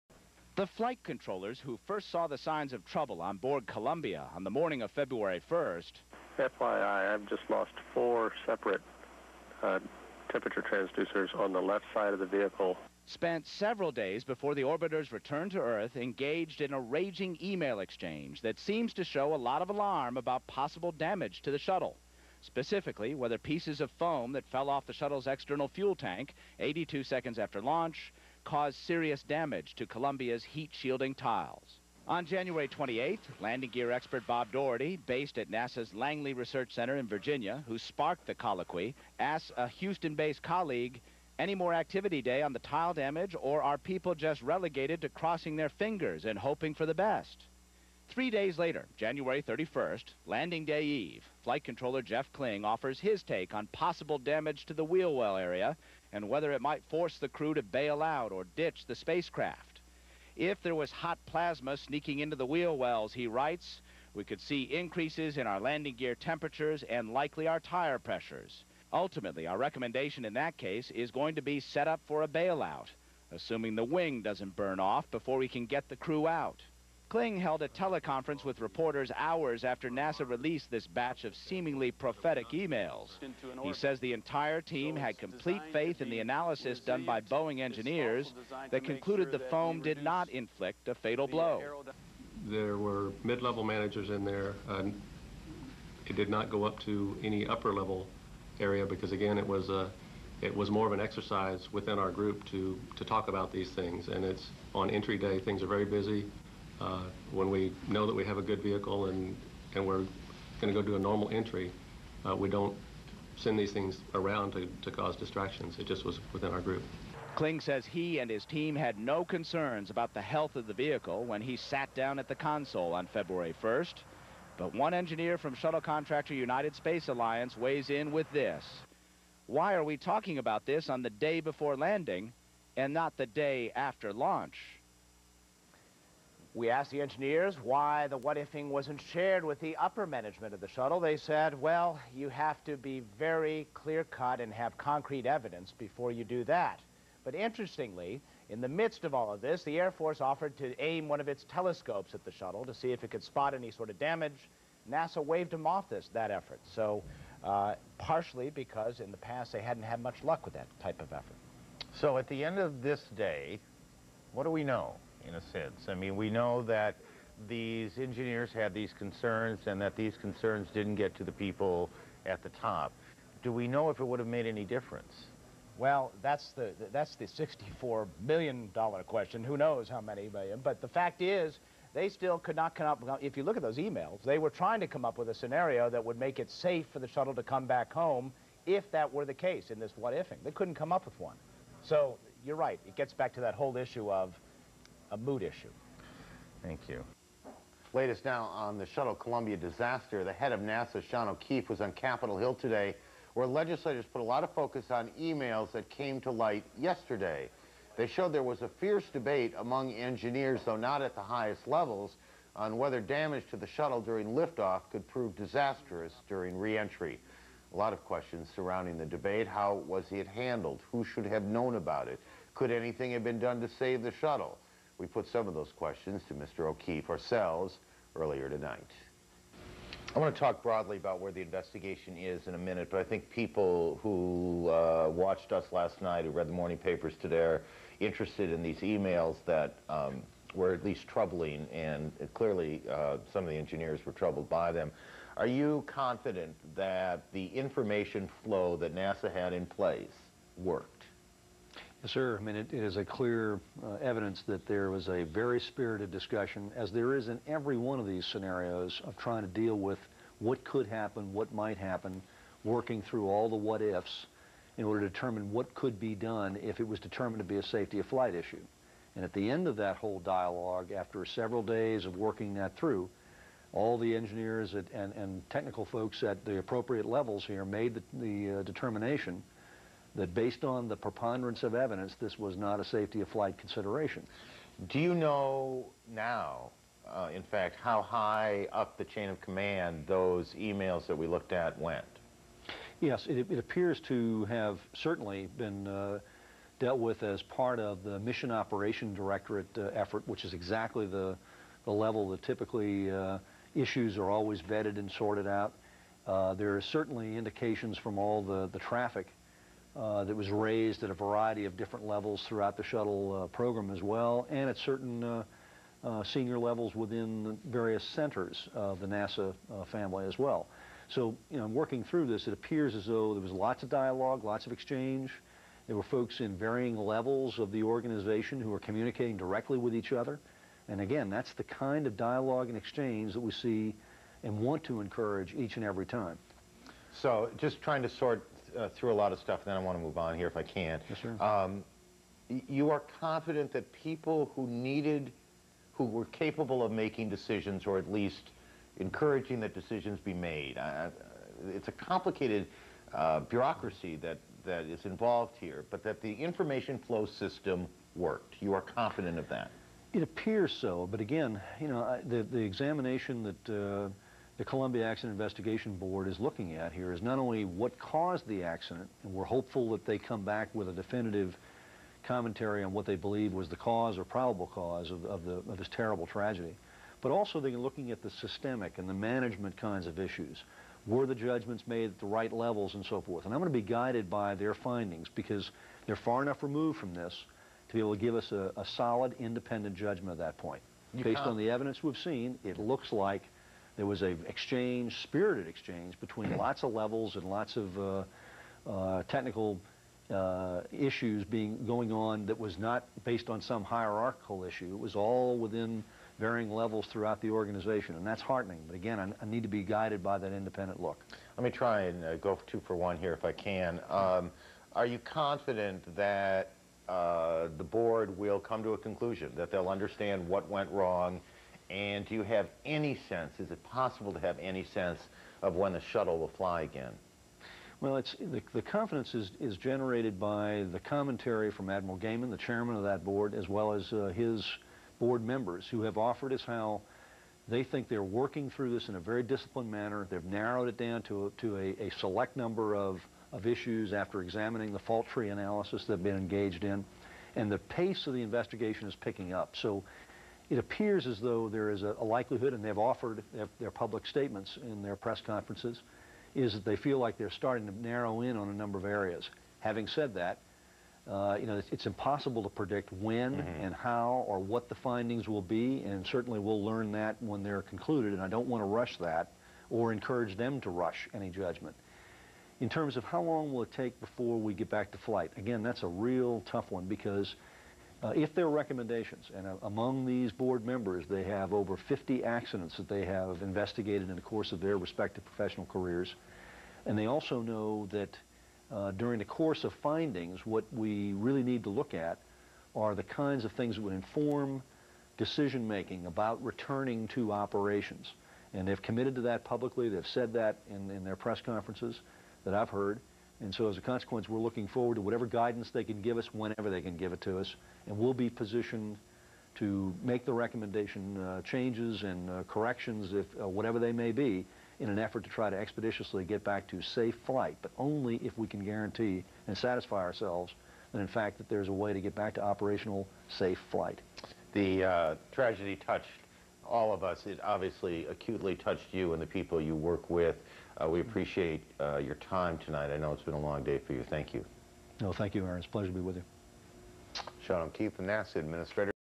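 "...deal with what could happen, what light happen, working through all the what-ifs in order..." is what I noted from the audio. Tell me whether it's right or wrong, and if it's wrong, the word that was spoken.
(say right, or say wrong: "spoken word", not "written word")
wrong: "might", not "light".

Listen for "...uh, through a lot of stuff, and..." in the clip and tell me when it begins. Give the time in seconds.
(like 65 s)
338 s.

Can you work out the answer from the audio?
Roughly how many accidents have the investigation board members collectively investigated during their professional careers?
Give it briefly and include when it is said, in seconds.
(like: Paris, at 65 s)
Over 50, at 481 s.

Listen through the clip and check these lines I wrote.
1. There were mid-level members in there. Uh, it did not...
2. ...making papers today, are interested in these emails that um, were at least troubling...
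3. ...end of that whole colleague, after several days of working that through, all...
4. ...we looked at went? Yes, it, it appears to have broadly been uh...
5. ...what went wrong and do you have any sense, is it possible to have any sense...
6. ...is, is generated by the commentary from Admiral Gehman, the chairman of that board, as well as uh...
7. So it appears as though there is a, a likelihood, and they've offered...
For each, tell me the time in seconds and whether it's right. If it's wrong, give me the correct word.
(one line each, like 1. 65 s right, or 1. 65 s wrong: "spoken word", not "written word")
1. 92 s wrong: "managers", not "members"
2. 236 s wrong: "morning", not "making"
3. 269 s wrong: "dialogue", not "colleague"
4. 291 s wrong: "certainly", not "broadly"
5. 420 s right
6. 429 s right
7. 449 s right.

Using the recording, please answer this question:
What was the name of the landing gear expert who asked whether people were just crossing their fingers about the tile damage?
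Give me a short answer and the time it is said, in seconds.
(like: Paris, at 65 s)
Bob Daugherty, at 34 s.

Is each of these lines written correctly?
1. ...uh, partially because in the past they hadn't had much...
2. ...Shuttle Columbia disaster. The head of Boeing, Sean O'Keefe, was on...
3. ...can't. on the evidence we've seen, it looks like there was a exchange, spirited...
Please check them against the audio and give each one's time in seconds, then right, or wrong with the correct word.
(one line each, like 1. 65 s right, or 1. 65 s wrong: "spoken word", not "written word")
1. 157 s right
2. 198 s wrong: "NASA", not "Boeing"
3. 391 s right.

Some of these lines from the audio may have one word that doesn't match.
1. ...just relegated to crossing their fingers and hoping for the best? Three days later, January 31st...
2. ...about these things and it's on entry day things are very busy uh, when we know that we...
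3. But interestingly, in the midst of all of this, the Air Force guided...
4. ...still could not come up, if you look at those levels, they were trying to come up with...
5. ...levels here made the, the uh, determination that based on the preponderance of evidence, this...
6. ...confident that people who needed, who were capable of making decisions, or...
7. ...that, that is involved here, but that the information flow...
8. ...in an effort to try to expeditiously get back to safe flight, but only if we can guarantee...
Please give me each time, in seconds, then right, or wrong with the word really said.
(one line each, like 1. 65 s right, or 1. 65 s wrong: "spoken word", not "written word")
1. 44 s right
2. 103 s right
3. 147 s wrong: "offered", not "guided"
4. 182 s wrong: "emails", not "levels"
5. 277 s right
6. 343 s right
7. 354 s right
8. 514 s right.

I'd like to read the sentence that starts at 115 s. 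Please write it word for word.
It just was within our group.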